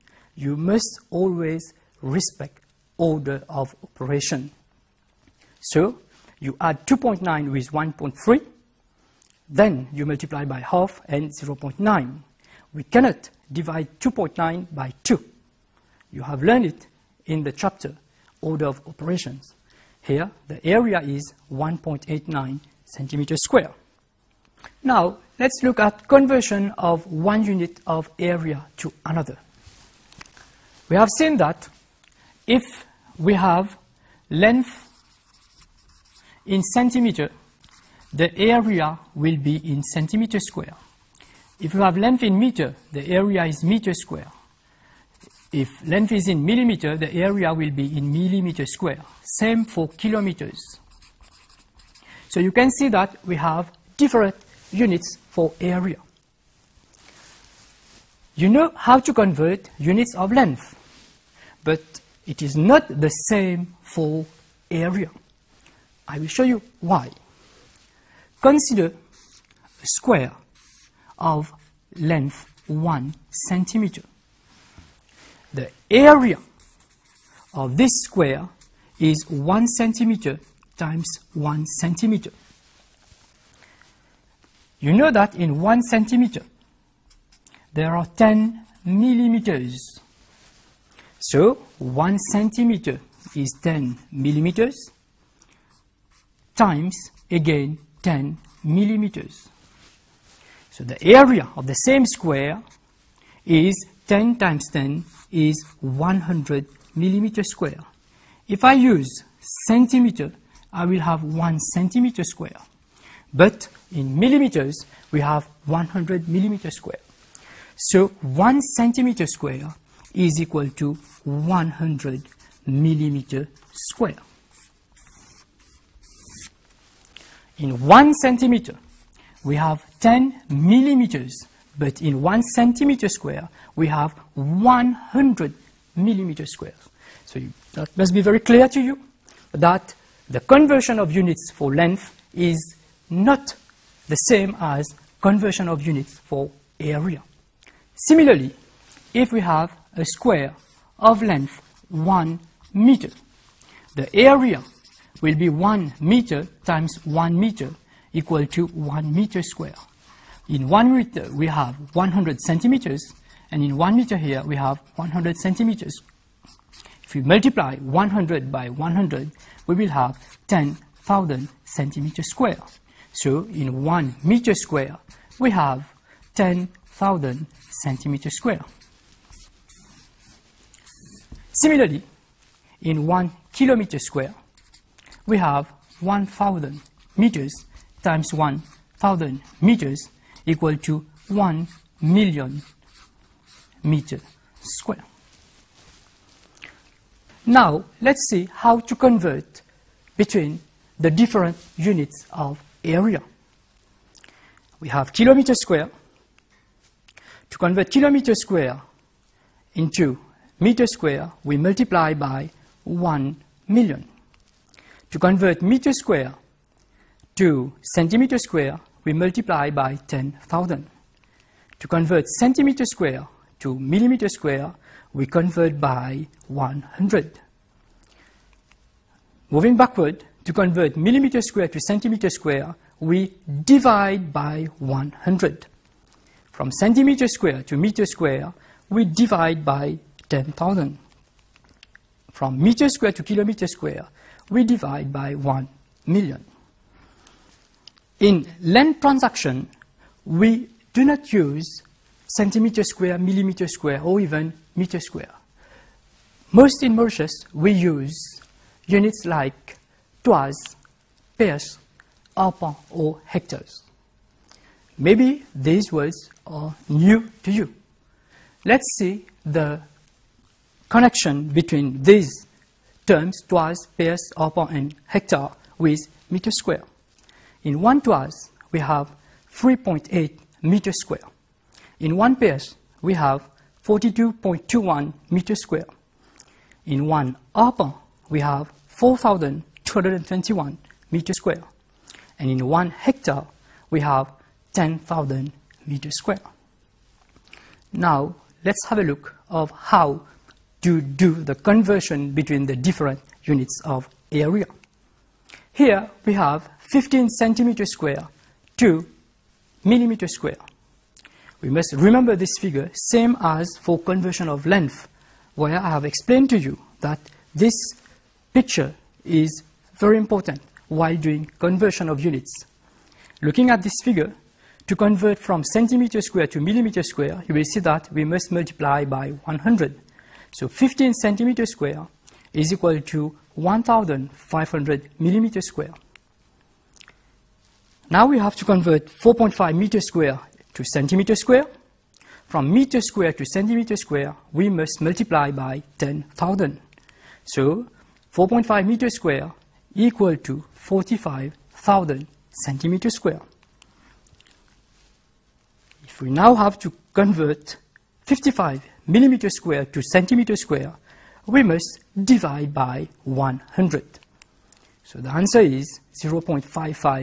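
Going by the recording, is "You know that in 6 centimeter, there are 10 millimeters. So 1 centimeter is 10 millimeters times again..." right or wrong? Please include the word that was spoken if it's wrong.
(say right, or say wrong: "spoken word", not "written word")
wrong: "1", not "6".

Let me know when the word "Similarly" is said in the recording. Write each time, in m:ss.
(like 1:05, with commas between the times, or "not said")
2:27, 3:01.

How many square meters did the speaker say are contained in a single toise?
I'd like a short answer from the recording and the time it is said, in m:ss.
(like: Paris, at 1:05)
3.8 m², at 4:39.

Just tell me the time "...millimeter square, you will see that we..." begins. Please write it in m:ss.
5:26.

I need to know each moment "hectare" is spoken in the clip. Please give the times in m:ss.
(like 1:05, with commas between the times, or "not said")
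4:23, 4:35, 4:52.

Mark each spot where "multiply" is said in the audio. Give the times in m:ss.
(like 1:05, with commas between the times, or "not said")
0:10, 2:47, 3:31, 3:39, 5:28, 5:45.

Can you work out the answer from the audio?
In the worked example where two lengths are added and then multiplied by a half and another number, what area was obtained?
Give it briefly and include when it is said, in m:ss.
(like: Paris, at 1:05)
1.89 cm², at 0:21.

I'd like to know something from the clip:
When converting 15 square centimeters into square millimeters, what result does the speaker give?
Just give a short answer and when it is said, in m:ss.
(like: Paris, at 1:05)
1,500 mm², at 5:33.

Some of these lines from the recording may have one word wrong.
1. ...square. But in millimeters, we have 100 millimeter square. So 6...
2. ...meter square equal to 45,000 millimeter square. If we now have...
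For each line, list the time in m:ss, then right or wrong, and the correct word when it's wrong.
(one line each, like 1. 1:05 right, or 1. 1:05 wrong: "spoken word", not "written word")
1. 1:52 wrong: "1", not "6"
2. 5:48 wrong: "centimeter", not "millimeter".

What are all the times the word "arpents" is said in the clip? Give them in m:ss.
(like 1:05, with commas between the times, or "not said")
4:22, 4:34, 4:47.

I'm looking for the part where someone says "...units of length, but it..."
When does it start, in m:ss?
0:59.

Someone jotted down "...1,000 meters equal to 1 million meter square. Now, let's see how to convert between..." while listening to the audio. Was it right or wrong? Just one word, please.
right.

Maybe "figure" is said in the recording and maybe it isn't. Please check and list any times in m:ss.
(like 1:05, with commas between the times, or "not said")
5:12, 5:24.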